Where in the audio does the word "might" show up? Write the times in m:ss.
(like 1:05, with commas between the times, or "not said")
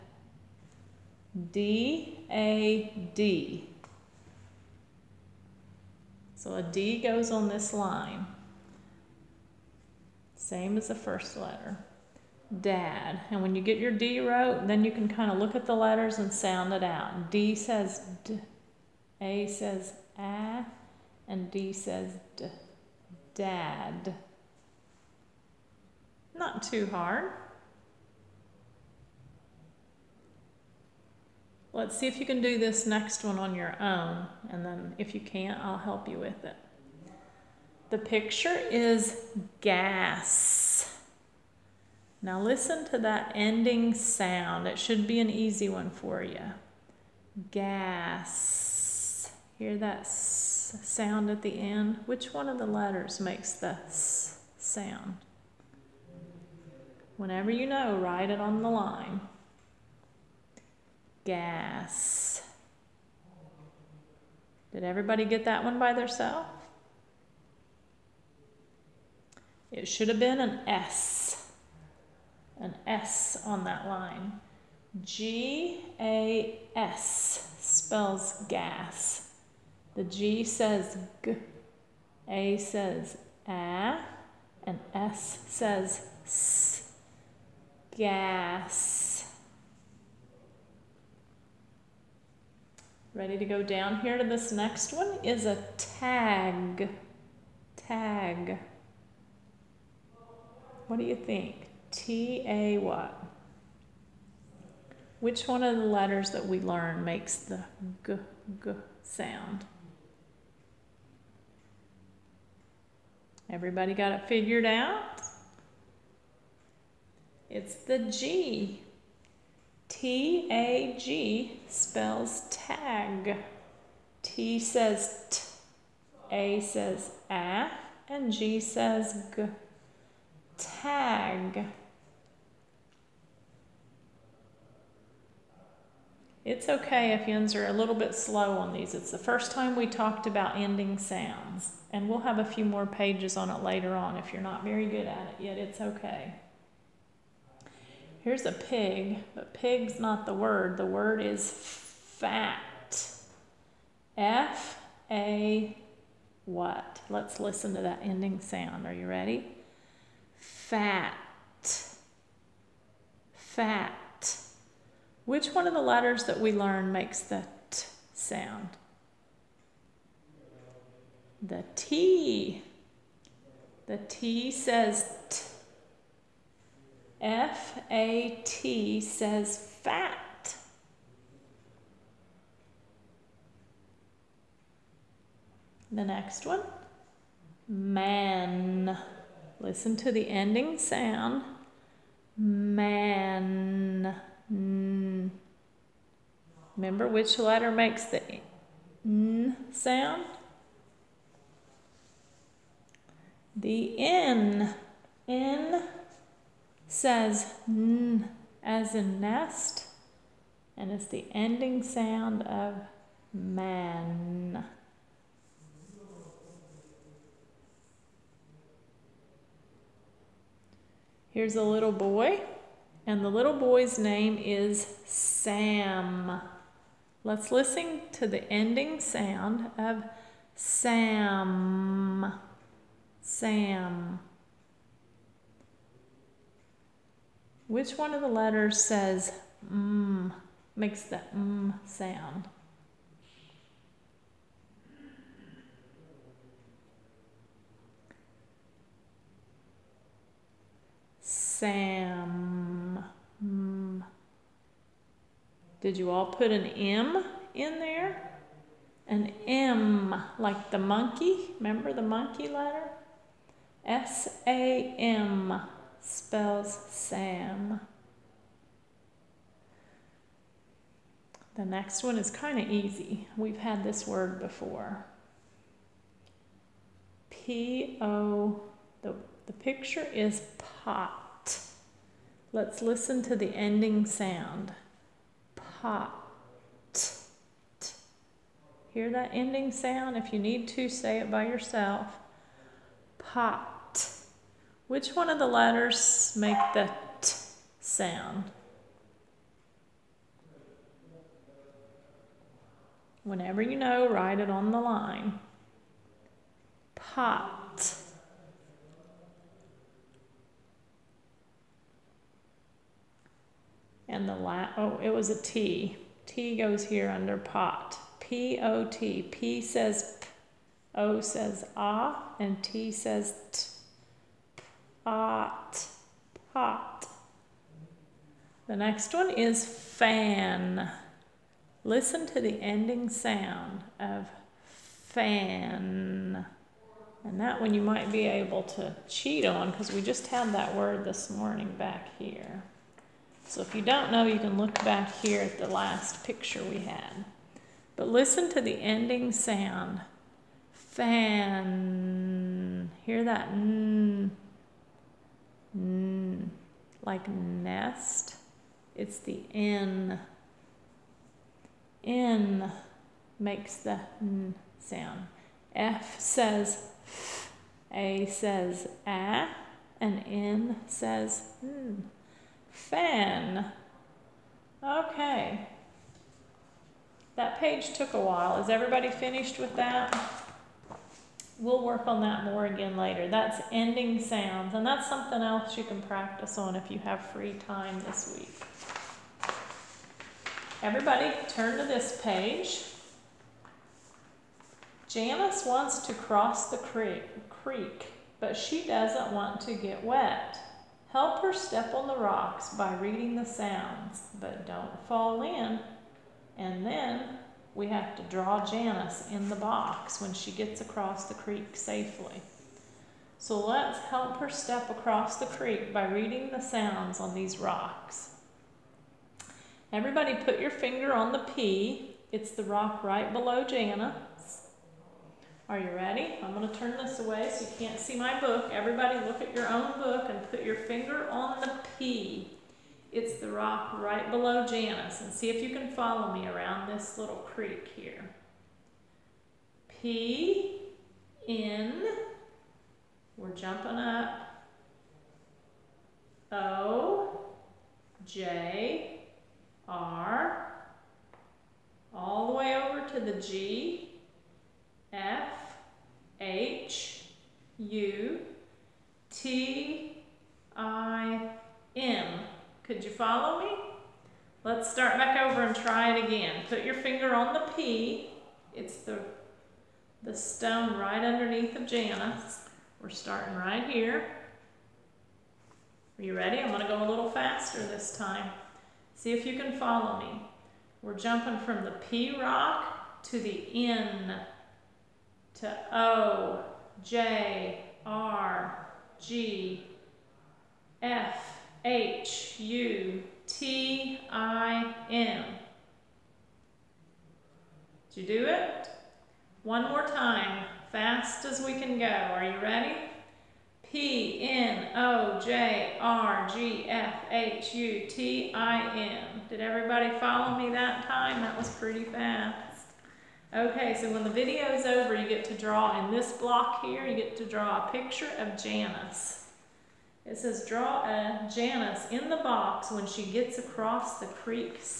5:37.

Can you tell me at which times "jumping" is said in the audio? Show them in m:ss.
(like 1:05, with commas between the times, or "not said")
7:23, 8:01.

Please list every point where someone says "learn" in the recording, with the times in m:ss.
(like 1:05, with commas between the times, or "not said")
1:46, 2:46.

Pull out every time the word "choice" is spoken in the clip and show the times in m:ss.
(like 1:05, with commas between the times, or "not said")
not said.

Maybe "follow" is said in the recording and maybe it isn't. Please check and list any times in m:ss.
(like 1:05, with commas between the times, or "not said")
7:15, 7:43, 7:59, 8:30.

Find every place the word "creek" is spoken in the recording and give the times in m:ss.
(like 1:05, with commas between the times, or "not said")
6:36, 6:51, 6:55, 7:17, 8:44.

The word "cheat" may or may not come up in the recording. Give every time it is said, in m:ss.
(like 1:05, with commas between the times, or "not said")
5:39.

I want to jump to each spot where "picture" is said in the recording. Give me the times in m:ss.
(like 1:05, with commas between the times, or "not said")
0:37, 4:39, 5:46, 8:37.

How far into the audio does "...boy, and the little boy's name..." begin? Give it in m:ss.
3:41.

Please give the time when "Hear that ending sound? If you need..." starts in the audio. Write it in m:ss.
4:48.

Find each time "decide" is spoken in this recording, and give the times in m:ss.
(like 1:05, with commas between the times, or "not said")
not said.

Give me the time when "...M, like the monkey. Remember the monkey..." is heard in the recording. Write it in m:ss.
4:19.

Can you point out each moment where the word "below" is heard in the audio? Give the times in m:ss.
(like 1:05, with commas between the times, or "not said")
7:03, 7:14.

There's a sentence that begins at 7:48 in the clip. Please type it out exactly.
It's the, the stone right underneath of Janice.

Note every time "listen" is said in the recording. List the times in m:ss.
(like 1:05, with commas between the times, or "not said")
0:42, 2:37, 3:09, 3:47, 4:42, 5:31, 5:48.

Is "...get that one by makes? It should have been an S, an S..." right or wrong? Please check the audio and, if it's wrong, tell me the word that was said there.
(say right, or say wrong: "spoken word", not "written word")
wrong: "themselves", not "makes".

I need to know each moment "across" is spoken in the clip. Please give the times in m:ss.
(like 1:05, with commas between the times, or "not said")
6:50, 6:54, 8:43.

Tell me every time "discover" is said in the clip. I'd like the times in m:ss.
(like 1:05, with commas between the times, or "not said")
not said.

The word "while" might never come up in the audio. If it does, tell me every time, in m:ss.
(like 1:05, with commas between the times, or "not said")
6:18.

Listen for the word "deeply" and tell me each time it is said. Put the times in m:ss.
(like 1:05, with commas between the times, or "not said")
not said.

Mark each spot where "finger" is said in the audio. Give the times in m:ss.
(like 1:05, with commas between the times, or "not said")
7:00, 7:10, 7:46.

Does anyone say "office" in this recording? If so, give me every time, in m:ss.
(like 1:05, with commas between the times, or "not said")
not said.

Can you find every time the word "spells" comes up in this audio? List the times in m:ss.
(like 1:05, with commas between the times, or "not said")
1:17, 2:01, 4:26.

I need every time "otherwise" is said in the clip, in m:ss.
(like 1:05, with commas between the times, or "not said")
not said.